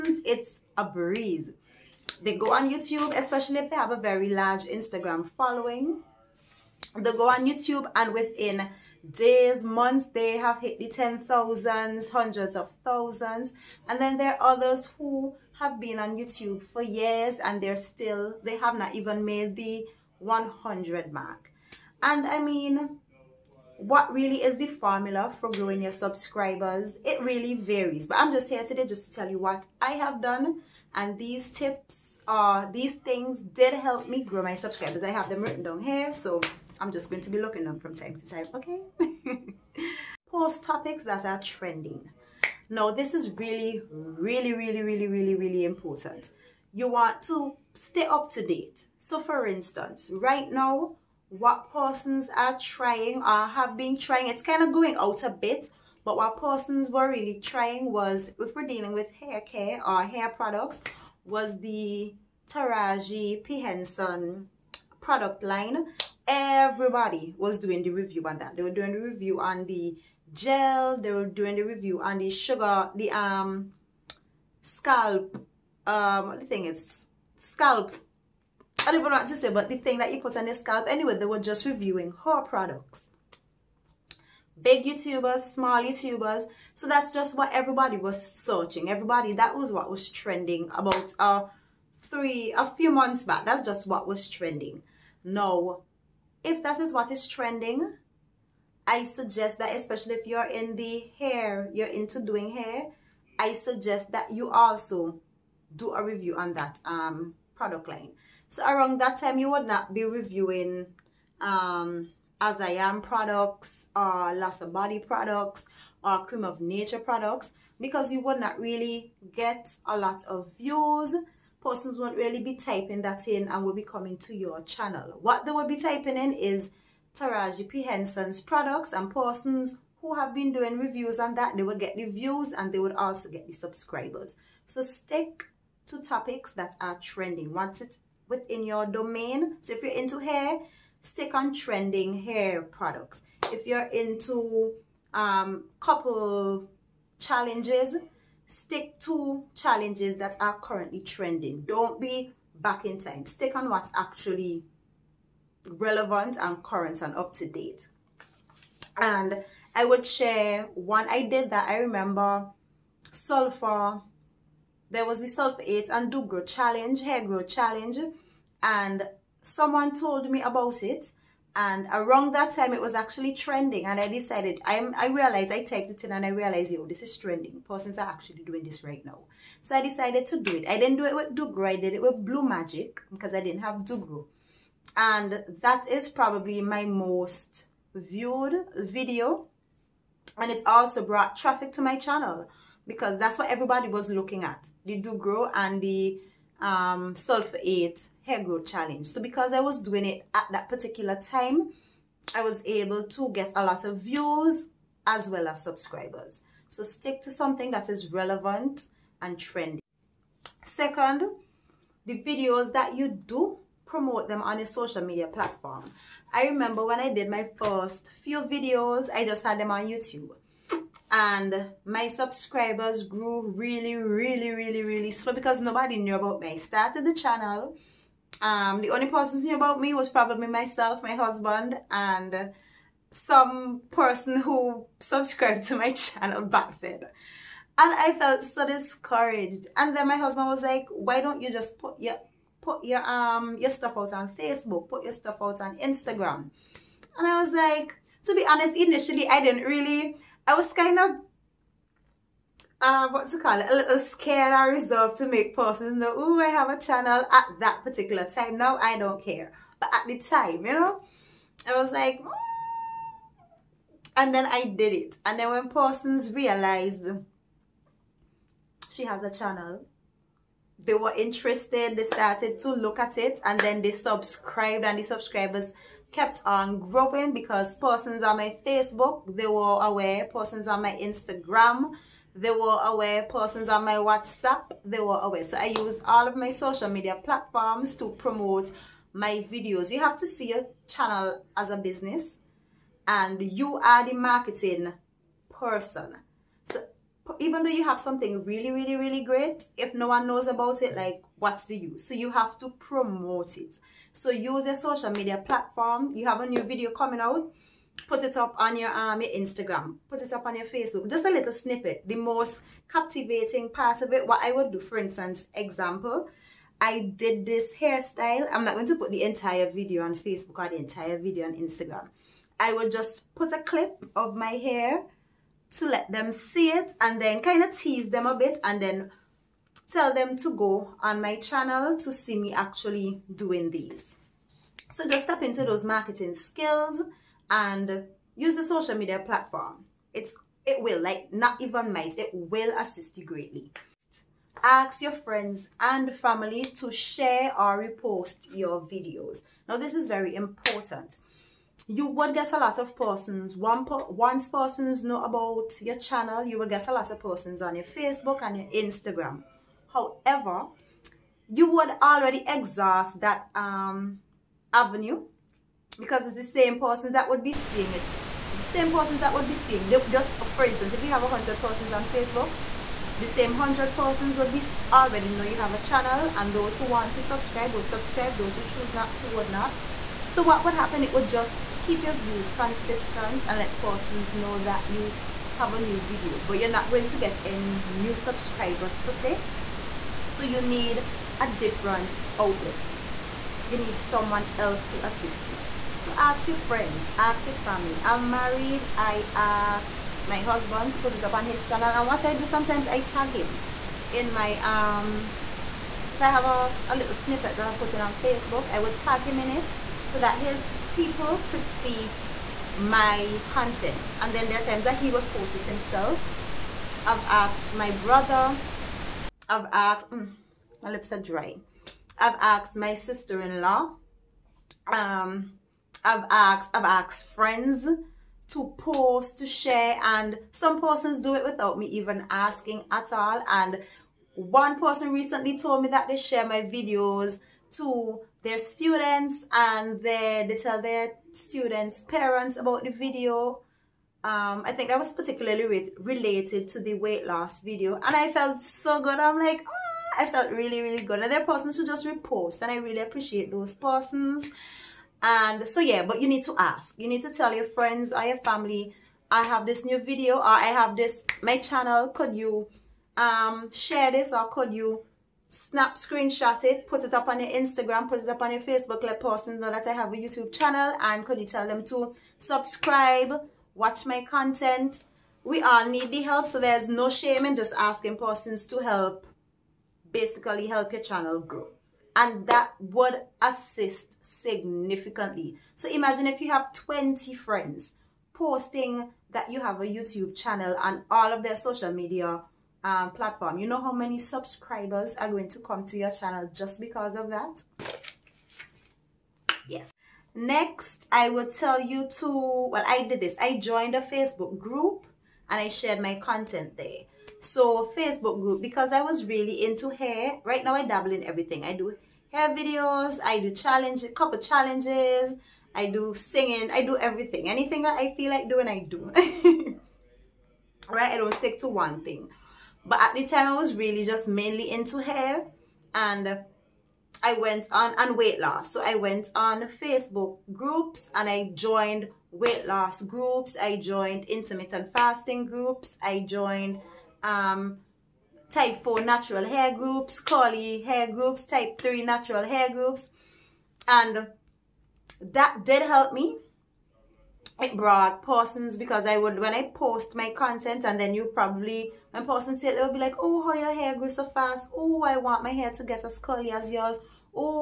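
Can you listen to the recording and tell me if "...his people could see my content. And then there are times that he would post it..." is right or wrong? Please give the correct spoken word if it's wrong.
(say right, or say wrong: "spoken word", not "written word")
right.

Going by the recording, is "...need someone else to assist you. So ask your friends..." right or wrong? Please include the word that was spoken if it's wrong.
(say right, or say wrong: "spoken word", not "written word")
right.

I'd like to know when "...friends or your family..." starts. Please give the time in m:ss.
7:37.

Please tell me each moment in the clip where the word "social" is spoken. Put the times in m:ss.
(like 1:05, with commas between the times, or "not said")
3:34, 4:46, 5:04, 5:38, 8:11.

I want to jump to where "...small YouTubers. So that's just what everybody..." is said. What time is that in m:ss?
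1:25.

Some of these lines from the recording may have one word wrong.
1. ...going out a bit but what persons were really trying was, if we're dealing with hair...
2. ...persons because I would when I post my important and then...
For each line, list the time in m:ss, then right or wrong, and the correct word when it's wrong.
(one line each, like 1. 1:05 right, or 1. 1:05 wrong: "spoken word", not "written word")
1. 0:54 right
2. 9:08 wrong: "content", not "important".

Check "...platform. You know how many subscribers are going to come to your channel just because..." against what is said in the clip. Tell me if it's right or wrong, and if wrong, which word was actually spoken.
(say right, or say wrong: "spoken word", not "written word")
right.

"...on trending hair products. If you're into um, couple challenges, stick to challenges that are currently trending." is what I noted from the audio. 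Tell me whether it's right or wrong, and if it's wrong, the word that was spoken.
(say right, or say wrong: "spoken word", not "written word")
right.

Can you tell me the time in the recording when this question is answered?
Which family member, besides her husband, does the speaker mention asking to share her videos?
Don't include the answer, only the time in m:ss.
7:02.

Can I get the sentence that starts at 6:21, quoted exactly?
It would just keep your views consistent and let persons know that you have a new video.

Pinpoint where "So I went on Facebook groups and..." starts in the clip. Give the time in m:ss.
8:48.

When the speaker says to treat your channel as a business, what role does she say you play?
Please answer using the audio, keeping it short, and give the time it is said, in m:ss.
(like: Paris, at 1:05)
marketing person, at 4:54.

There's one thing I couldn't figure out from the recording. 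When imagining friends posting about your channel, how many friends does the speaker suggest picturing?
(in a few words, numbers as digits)
20.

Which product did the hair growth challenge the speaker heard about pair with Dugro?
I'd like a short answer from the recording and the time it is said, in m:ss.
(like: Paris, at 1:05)
Sulfur 8, at 2:45.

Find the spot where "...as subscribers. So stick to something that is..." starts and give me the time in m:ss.
3:25.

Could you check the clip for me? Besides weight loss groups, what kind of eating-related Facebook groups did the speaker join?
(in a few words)
intermittent fasting.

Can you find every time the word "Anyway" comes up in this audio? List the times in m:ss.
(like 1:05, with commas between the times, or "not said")
1:20.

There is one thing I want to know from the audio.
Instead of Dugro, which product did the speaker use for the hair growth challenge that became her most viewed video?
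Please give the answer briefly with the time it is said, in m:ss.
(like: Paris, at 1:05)
Blue Magic, at 3:02.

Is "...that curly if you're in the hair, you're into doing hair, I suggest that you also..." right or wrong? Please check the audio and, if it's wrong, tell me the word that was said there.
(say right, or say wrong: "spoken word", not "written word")
wrong: "especially", not "curly".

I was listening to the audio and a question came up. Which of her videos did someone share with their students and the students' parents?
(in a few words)
weight loss video.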